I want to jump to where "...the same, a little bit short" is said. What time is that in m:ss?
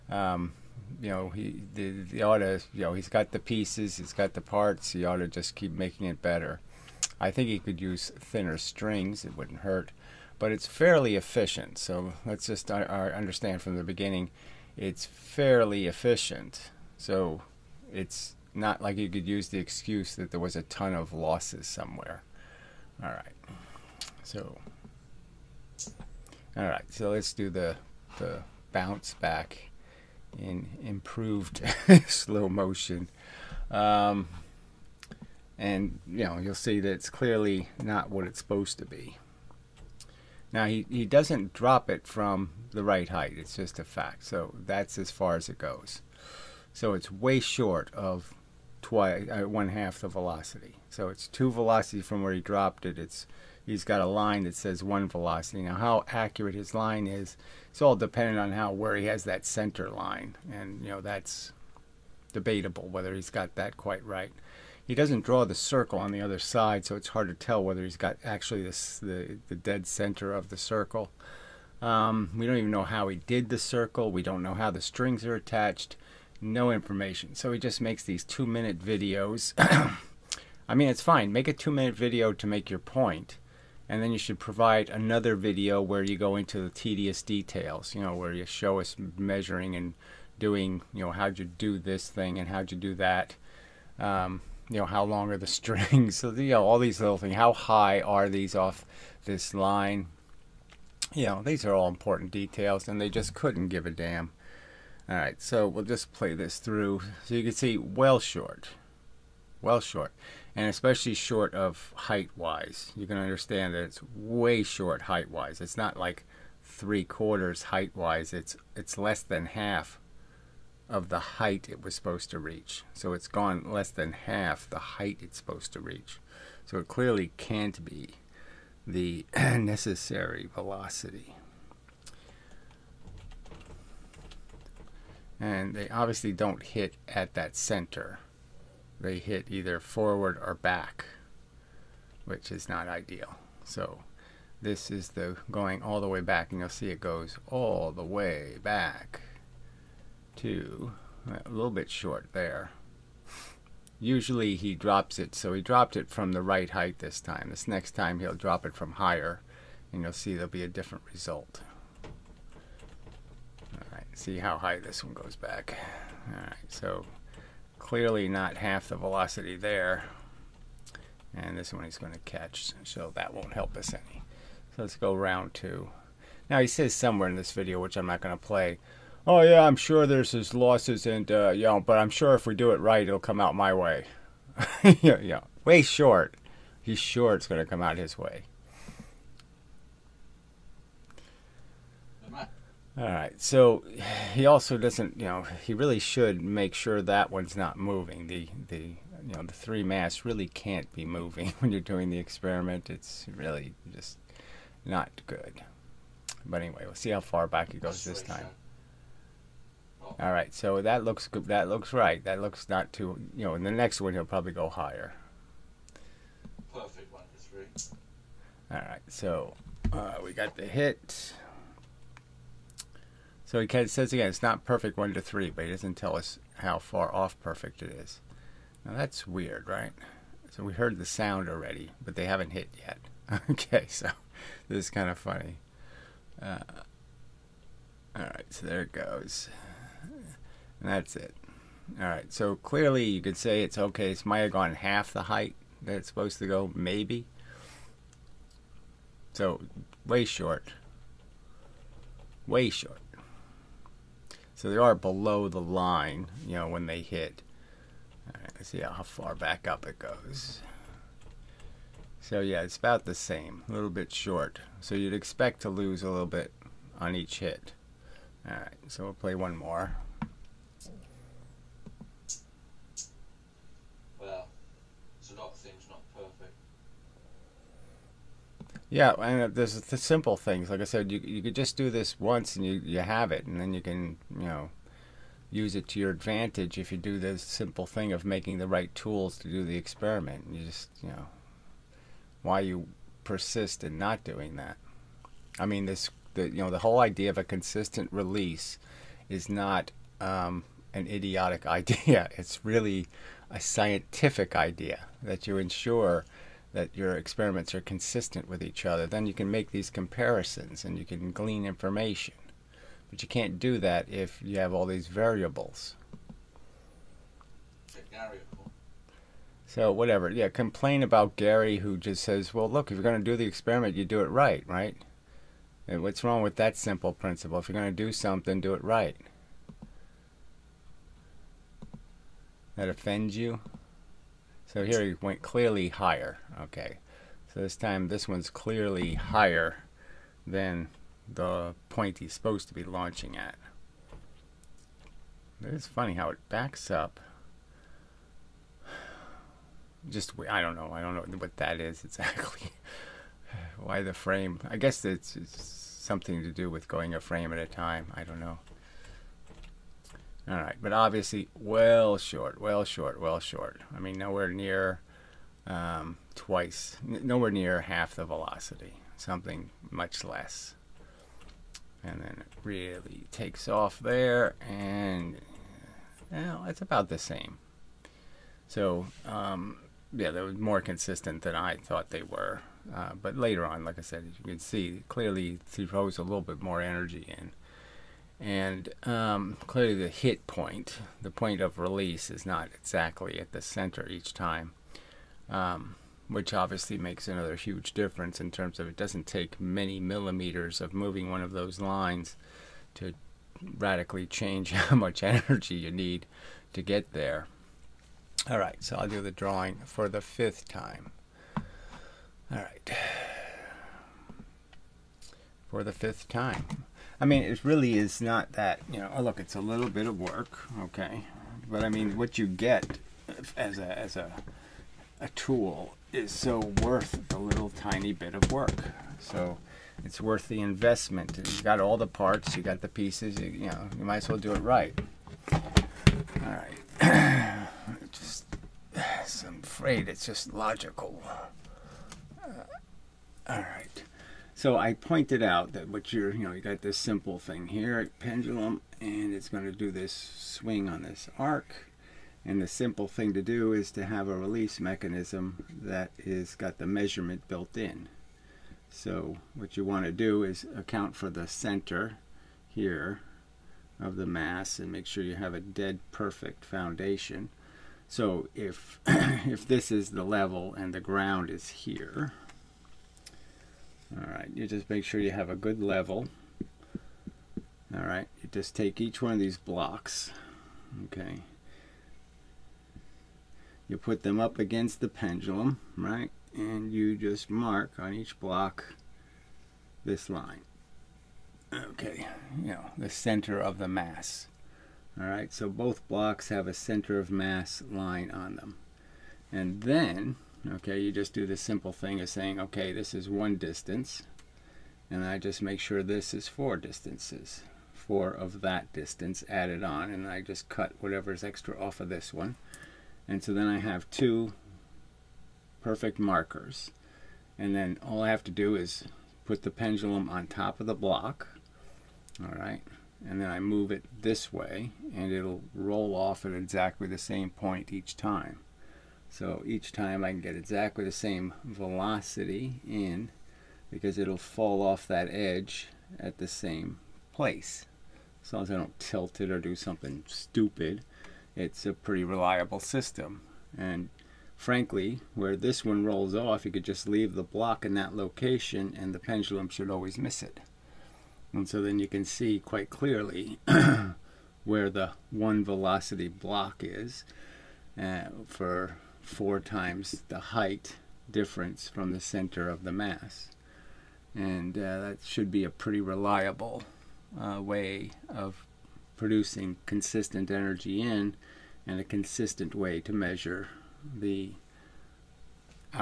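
4:23.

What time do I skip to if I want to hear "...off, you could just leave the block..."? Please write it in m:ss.
9:06.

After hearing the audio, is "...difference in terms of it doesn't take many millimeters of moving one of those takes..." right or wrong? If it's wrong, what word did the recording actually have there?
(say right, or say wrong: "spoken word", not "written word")
wrong: "lines", not "takes".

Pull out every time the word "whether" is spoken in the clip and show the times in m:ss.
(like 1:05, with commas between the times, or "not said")
1:02, 1:07.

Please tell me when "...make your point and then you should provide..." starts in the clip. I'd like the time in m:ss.
1:22.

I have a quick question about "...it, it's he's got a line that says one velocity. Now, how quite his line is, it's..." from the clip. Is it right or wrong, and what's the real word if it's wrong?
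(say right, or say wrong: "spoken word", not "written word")
wrong: "accurate", not "quite".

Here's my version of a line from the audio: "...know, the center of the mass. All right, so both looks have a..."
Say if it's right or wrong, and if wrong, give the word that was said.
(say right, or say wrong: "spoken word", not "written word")
wrong: "blocks", not "looks".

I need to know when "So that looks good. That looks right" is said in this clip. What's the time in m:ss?
3:30.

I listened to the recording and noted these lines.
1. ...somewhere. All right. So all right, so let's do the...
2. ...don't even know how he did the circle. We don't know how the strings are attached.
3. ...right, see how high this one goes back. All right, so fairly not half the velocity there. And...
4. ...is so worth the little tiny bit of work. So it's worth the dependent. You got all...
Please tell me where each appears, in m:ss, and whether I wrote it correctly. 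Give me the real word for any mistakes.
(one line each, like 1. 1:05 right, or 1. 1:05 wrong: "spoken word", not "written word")
1. 0:21 right
2. 1:12 right
3. 2:43 wrong: "clearly", not "fairly"
4. 7:06 wrong: "investment", not "dependent".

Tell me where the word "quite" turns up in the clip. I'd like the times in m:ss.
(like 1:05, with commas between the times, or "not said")
1:03, 9:12.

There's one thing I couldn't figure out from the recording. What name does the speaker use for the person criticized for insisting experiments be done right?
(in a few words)
Gary.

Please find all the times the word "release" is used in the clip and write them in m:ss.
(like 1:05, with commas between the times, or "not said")
4:58, 6:31, 7:34.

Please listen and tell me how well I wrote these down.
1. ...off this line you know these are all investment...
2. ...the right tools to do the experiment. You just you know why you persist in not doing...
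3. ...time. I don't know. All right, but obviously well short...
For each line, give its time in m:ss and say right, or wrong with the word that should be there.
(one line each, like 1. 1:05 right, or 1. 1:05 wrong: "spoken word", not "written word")
1. 1:38 wrong: "important", not "investment"
2. 4:48 right
3. 5:57 right.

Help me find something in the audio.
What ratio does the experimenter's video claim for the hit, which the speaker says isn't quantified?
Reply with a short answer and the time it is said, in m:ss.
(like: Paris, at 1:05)
One to three, at 3:44.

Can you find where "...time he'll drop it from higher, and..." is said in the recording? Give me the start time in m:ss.
2:37.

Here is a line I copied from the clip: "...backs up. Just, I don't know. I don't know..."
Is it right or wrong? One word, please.
right.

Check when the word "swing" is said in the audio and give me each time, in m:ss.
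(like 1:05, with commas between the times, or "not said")
7:30.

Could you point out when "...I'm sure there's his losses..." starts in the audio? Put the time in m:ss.
2:59.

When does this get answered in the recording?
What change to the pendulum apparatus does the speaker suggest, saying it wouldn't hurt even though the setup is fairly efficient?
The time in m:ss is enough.
0:08.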